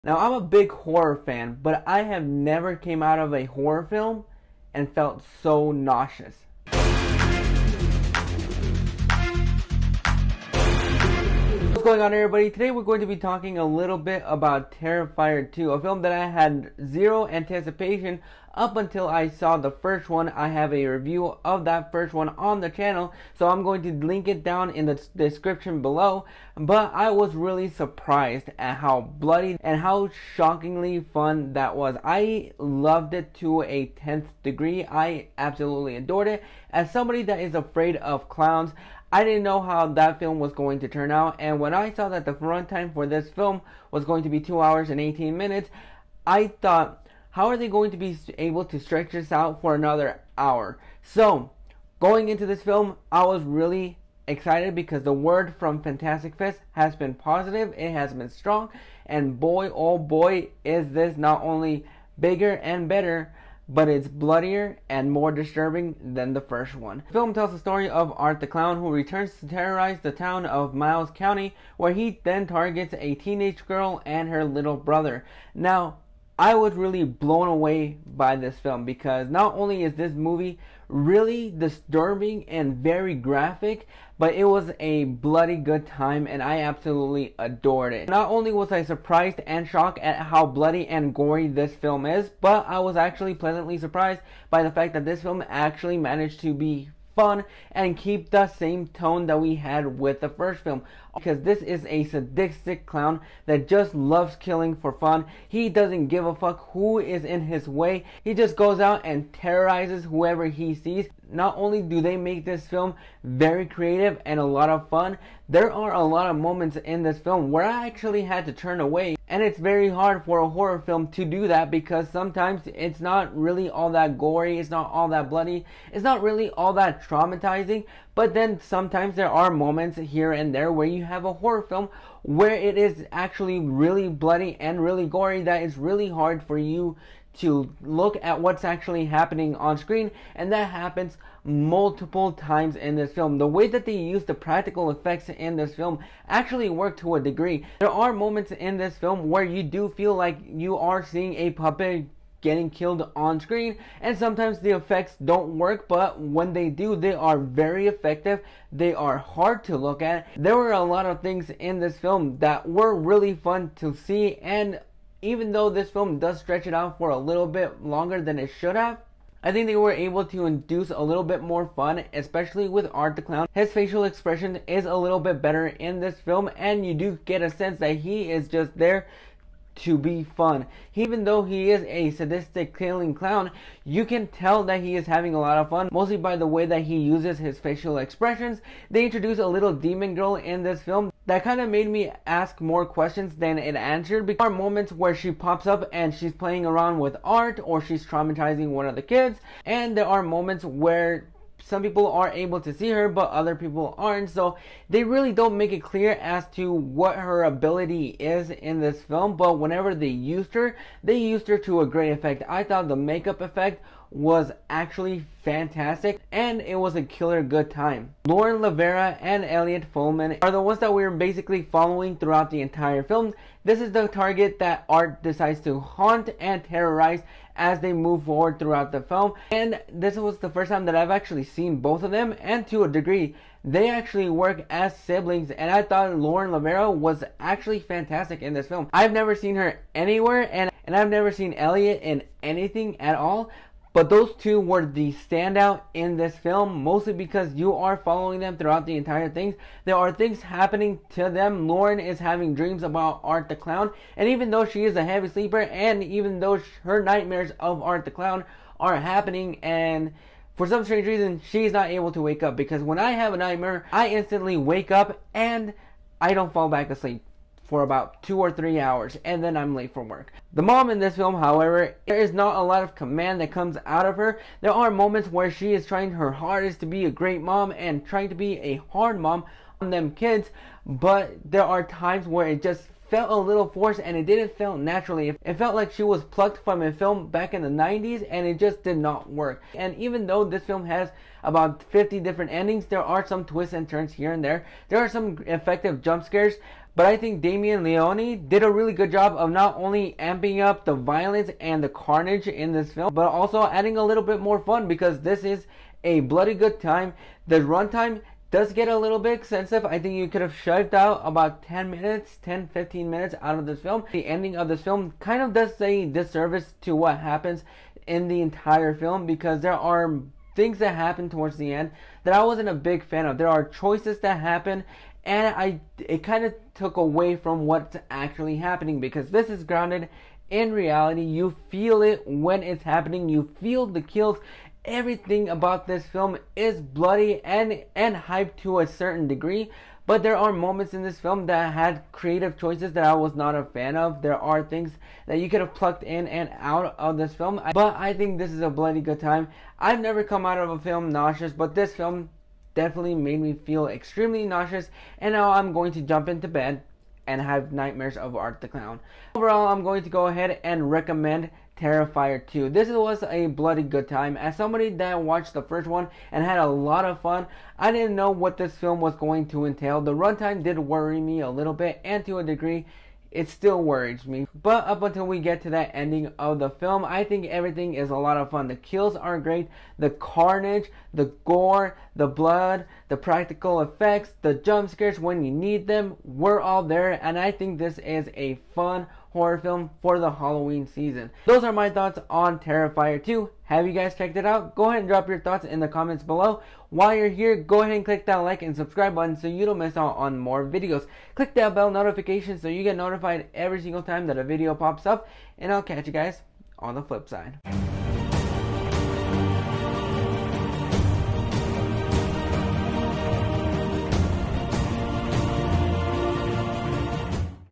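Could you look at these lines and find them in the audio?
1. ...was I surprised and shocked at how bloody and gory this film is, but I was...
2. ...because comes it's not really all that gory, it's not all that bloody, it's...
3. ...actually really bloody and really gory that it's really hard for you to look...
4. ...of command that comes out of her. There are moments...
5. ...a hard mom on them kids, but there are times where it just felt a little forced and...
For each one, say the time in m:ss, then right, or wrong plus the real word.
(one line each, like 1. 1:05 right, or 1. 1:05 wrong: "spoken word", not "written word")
1. 1:28 right
2. 2:01 wrong: "sometimes", not "comes"
3. 2:13 right
4. 4:32 right
5. 4:38 right.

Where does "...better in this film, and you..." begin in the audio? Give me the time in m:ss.
2:55.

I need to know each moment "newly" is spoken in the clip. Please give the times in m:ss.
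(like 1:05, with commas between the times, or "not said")
not said.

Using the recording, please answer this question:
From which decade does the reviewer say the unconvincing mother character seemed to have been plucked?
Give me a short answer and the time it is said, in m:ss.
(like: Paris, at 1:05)
the 90s, at 4:47.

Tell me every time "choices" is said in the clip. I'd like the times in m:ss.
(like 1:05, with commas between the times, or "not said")
5:23, 5:42.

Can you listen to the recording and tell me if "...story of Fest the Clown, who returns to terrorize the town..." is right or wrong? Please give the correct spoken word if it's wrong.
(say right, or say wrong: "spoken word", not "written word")
wrong: "Art", not "Fest".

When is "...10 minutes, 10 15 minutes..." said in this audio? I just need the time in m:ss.
5:11.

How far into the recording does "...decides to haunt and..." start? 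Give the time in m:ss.
3:45.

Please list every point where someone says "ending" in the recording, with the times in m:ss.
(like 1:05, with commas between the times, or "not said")
4:52, 5:14, 6:15.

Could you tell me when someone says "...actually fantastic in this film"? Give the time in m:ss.
3:57.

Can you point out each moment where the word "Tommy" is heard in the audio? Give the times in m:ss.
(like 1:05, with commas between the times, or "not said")
not said.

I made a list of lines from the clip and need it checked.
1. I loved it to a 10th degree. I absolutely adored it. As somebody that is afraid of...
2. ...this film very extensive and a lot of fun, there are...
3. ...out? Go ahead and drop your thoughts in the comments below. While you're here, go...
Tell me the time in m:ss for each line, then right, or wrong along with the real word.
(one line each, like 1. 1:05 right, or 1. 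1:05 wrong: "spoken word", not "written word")
1. 0:32 right
2. 1:52 wrong: "creative", not "extensive"
3. 6:34 right.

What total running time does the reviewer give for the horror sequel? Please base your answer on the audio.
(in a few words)
2 hours and 18 minutes.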